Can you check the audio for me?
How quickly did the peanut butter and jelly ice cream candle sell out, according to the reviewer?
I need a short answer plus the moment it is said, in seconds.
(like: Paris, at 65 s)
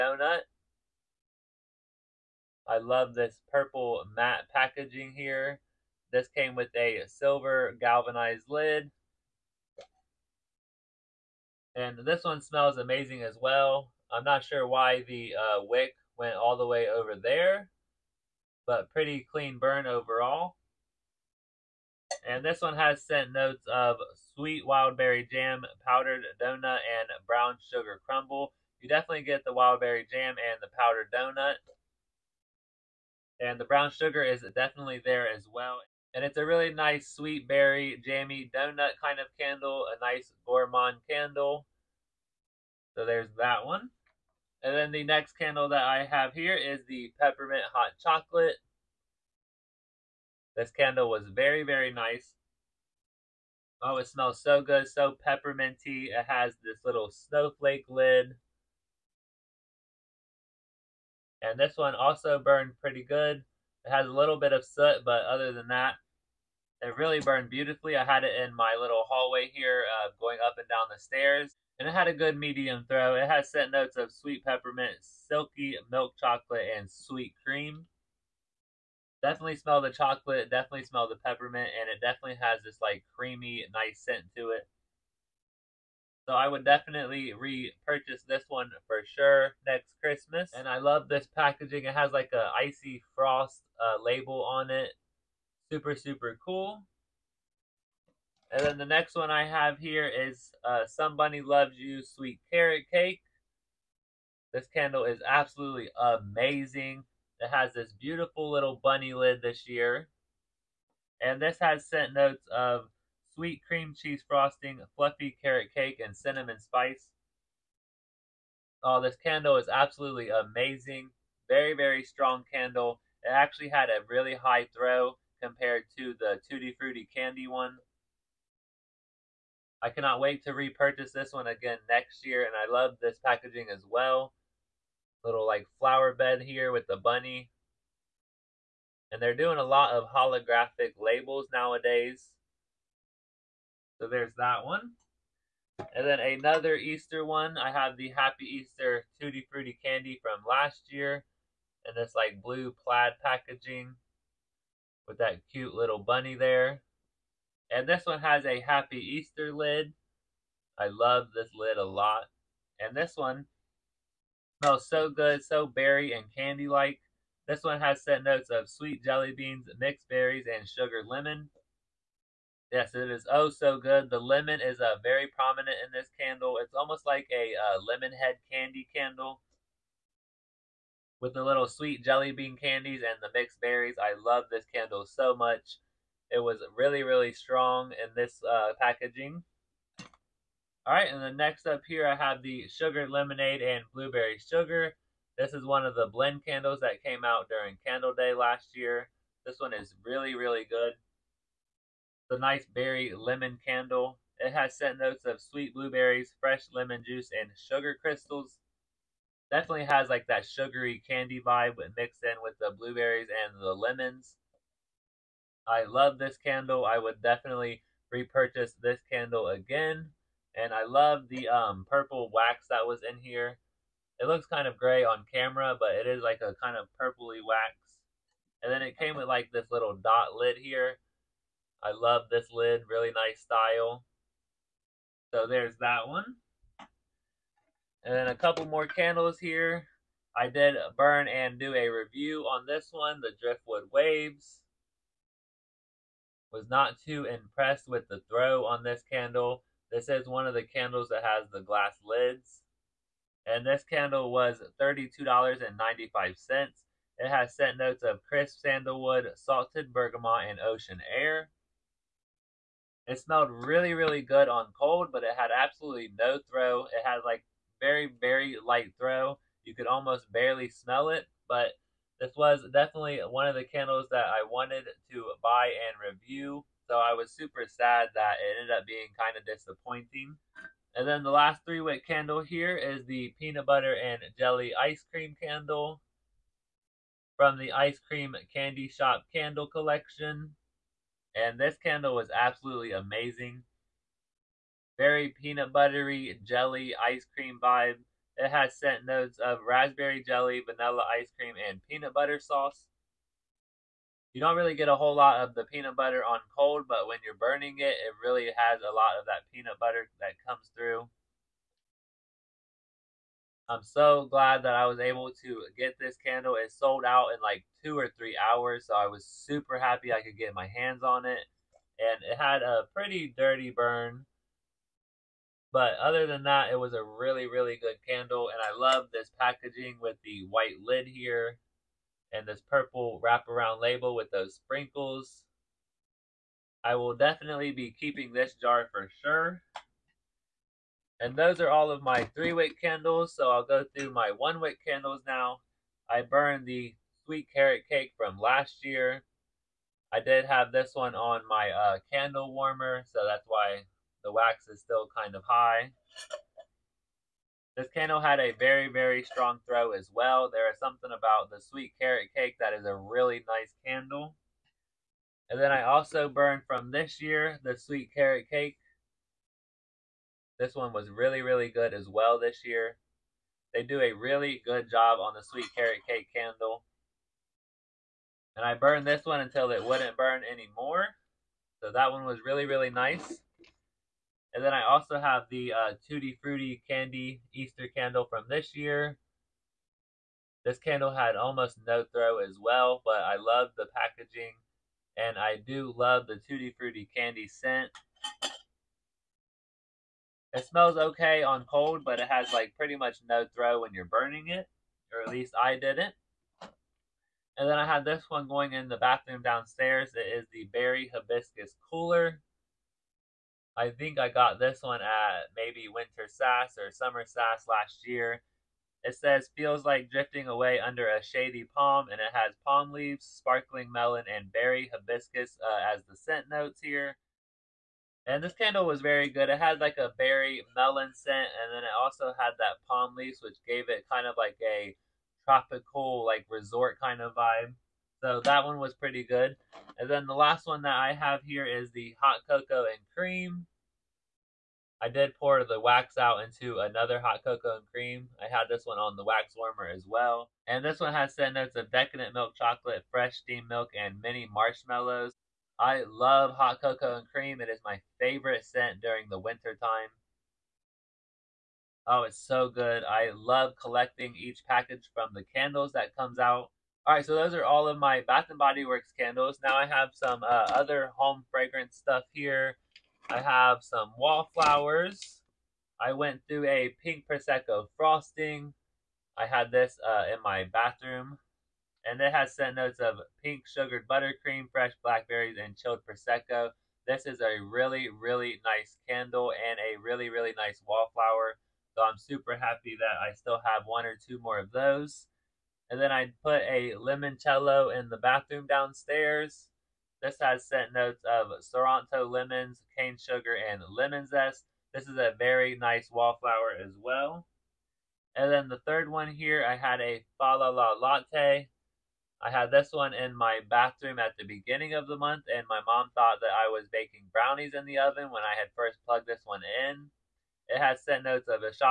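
Two or three hours, at 317 s.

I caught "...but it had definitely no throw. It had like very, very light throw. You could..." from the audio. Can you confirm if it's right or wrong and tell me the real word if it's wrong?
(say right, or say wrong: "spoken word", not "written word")
wrong: "absolutely", not "definitely".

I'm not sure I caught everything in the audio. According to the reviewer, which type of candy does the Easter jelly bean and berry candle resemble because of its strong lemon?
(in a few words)
Lemon head candy.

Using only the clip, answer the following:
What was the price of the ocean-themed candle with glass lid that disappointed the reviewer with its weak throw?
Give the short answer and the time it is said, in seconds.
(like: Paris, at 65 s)
$32.95, at 254 s.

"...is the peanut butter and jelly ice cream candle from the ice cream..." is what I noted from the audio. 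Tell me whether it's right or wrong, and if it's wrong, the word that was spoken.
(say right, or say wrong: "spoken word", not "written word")
right.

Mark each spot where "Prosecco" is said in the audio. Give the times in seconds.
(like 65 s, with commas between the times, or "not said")
477 s, 486 s.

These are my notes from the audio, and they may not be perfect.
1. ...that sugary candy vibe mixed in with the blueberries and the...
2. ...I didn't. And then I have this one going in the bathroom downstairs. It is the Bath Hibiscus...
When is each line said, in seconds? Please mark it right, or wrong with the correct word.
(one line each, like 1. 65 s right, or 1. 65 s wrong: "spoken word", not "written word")
1. 210 s right
2. 405 s wrong: "Berry", not "Bath".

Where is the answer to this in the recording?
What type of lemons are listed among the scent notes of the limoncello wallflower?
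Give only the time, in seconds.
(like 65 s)
501 s.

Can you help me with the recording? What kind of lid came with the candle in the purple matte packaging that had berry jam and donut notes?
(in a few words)
Silver galvanized lid.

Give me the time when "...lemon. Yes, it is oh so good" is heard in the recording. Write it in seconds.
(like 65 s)
171 s.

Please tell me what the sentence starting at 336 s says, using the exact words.
I will definitely be keeping this jar for sure.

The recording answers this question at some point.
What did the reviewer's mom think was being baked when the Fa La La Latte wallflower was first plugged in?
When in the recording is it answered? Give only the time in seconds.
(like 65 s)
517 s.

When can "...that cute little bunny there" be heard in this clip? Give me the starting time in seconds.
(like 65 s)
155 s.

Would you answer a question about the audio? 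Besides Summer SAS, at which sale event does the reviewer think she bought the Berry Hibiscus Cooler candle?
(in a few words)
Winter SAS.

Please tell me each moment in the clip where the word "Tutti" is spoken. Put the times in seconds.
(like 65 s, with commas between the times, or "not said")
126 s, 149 s, 386 s, 396 s.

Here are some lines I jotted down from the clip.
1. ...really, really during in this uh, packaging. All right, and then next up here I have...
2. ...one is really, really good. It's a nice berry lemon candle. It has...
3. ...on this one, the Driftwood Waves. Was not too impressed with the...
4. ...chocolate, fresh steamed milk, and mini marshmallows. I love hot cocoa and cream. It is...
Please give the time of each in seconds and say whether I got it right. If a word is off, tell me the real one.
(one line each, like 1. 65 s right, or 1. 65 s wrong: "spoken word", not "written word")
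1. 186 s wrong: "strong", not "during"
2. 199 s right
3. 242 s right
4. 452 s right.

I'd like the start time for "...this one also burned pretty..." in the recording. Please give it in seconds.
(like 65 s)
61 s.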